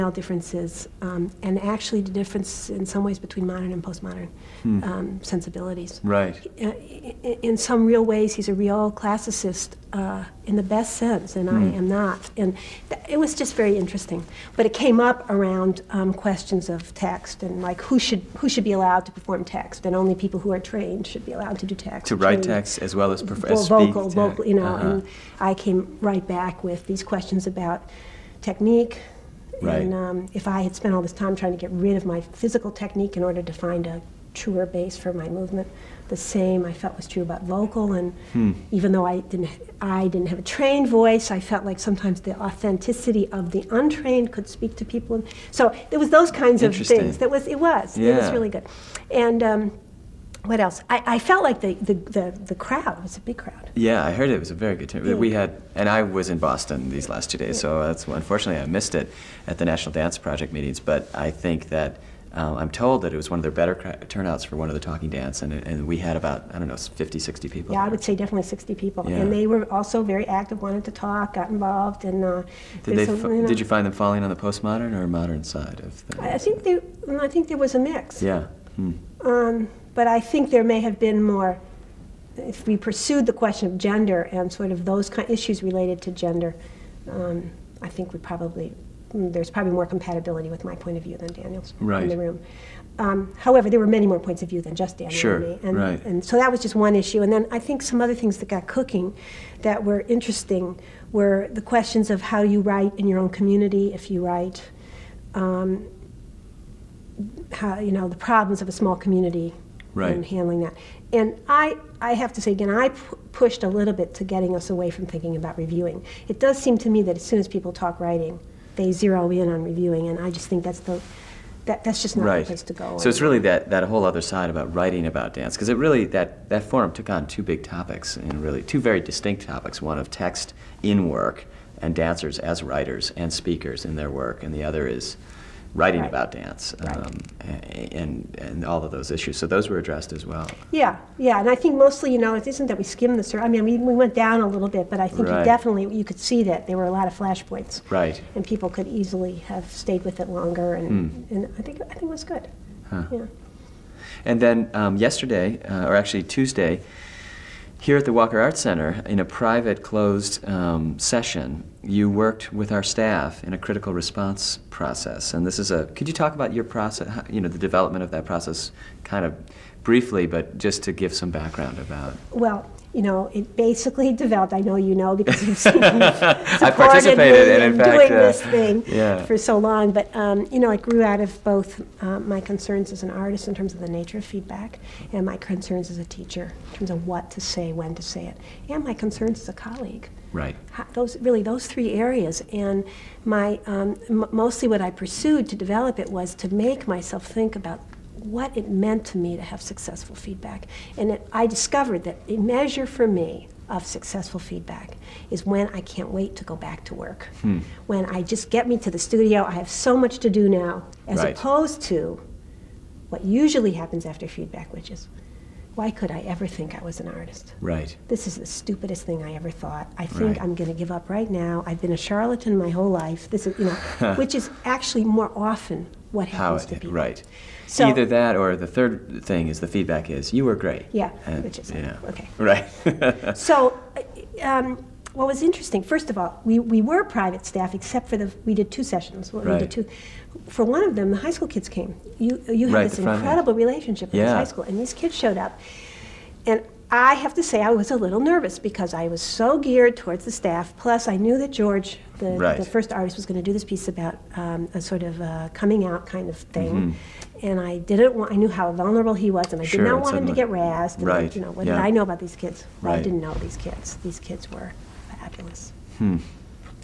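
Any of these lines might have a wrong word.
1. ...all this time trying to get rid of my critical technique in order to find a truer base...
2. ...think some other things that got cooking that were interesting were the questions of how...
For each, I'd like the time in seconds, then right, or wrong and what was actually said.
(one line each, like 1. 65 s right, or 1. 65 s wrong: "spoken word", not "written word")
1. 30 s wrong: "physical", not "critical"
2. 97 s right.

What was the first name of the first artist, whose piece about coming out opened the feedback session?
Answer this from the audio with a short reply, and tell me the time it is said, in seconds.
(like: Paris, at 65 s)
George, at 251 s.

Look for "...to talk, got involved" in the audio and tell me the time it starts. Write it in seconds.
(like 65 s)
70 s.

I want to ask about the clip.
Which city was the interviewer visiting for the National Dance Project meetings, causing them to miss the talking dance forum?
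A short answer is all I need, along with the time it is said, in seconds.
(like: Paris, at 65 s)
Boston, at 56 s.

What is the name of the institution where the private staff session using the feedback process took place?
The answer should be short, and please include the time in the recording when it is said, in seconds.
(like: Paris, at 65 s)
Walker Arts Center, at 158 s.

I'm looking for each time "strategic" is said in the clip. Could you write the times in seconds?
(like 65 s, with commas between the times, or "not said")
not said.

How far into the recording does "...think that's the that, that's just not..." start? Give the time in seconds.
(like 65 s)
120 s.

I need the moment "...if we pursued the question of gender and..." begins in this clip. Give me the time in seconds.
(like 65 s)
82 s.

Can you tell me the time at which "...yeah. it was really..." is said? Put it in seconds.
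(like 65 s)
47 s.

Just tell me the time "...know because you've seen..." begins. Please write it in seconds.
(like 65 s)
174 s.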